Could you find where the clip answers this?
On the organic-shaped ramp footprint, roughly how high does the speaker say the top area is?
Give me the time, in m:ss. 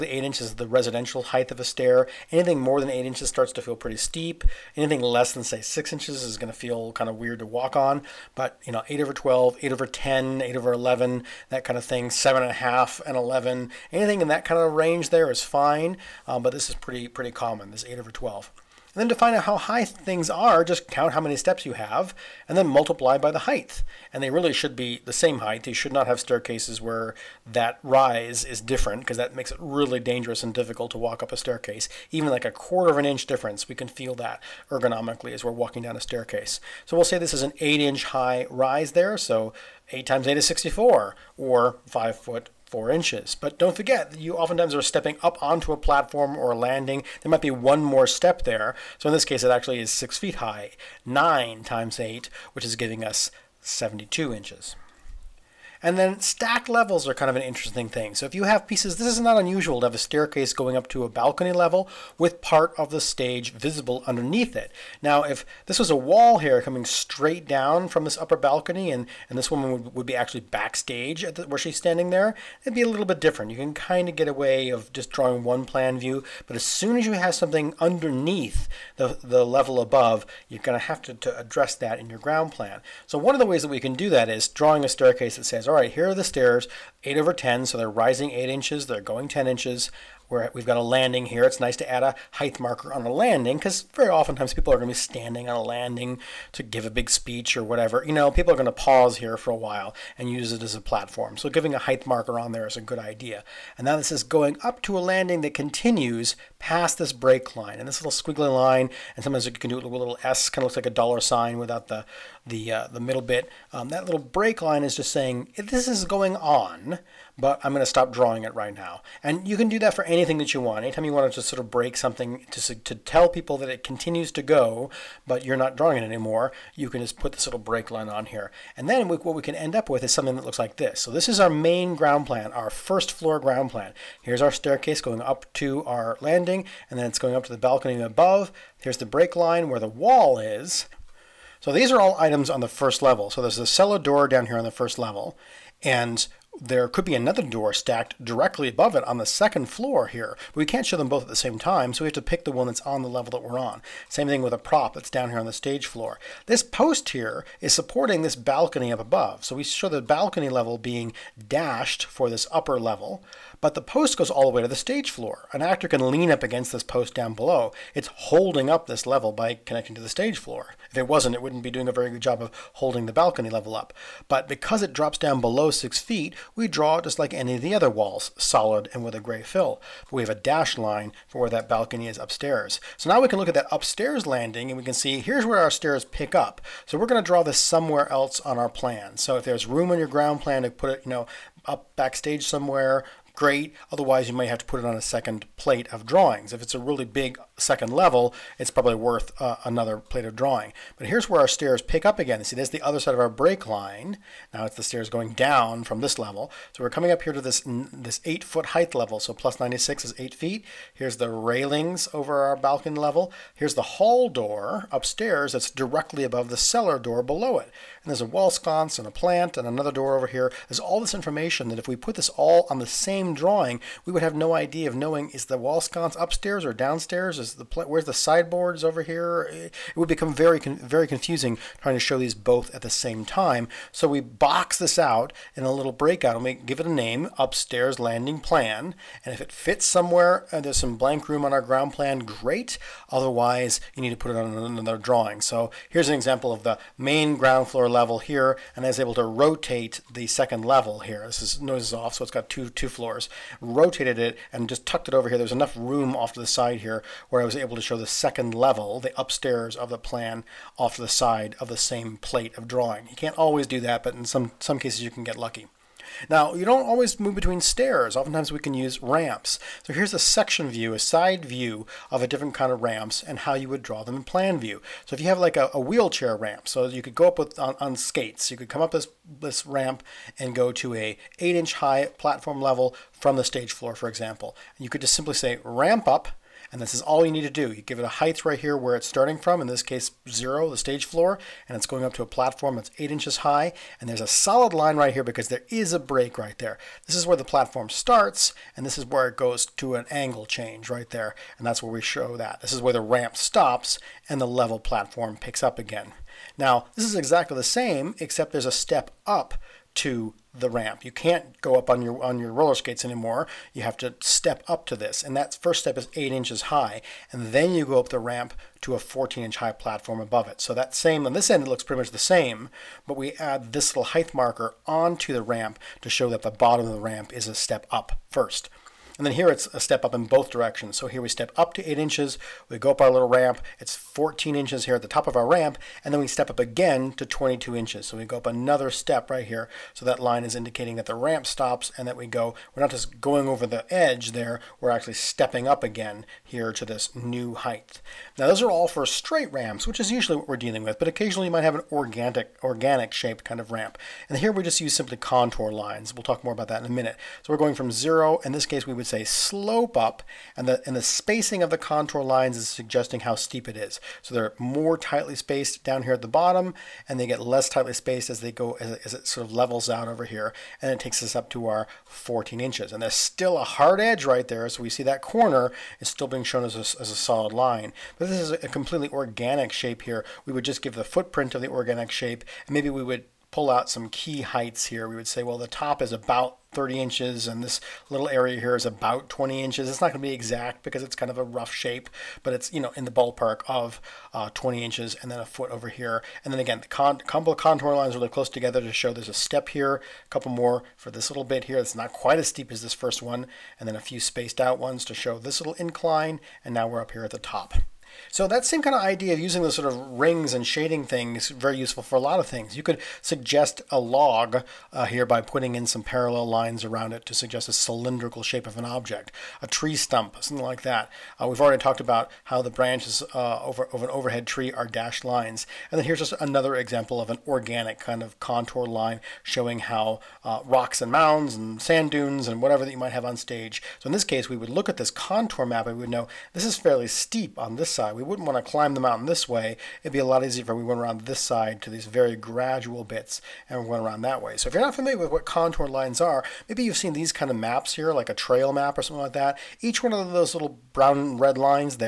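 6:26.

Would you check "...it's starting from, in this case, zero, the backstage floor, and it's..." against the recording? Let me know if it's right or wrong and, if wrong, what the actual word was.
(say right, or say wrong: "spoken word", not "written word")
wrong: "stage", not "backstage".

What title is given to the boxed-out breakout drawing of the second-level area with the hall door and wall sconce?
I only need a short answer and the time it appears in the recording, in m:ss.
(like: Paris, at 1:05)
Upstairs landing plan, at 3:57.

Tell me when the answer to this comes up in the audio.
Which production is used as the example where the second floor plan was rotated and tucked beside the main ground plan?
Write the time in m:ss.
4:11.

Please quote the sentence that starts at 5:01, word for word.
And that's where we show that.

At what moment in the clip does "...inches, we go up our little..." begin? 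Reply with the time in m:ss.
5:31.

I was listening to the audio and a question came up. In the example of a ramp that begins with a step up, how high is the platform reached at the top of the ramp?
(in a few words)
14 inches.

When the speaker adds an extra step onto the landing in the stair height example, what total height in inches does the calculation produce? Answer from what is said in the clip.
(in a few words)
72 inches.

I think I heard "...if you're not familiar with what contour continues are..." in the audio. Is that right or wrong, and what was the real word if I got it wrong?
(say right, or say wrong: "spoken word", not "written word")
wrong: "lines", not "continues".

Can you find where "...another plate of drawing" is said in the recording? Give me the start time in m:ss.
3:19.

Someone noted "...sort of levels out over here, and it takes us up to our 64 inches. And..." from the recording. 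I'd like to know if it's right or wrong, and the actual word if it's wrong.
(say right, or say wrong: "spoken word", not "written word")
wrong: "14", not "64".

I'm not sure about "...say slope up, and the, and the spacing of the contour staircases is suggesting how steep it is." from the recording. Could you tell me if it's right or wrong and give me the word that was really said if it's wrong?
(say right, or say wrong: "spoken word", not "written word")
wrong: "lines", not "staircases".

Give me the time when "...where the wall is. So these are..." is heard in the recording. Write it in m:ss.
2:19.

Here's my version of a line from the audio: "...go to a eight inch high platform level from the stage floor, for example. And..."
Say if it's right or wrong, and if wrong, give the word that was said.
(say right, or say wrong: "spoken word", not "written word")
right.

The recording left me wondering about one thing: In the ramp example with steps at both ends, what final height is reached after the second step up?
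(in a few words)
22 inches.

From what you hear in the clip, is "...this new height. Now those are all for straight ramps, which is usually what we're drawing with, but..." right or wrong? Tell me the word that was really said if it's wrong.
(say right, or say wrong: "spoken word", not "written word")
wrong: "dealing", not "drawing".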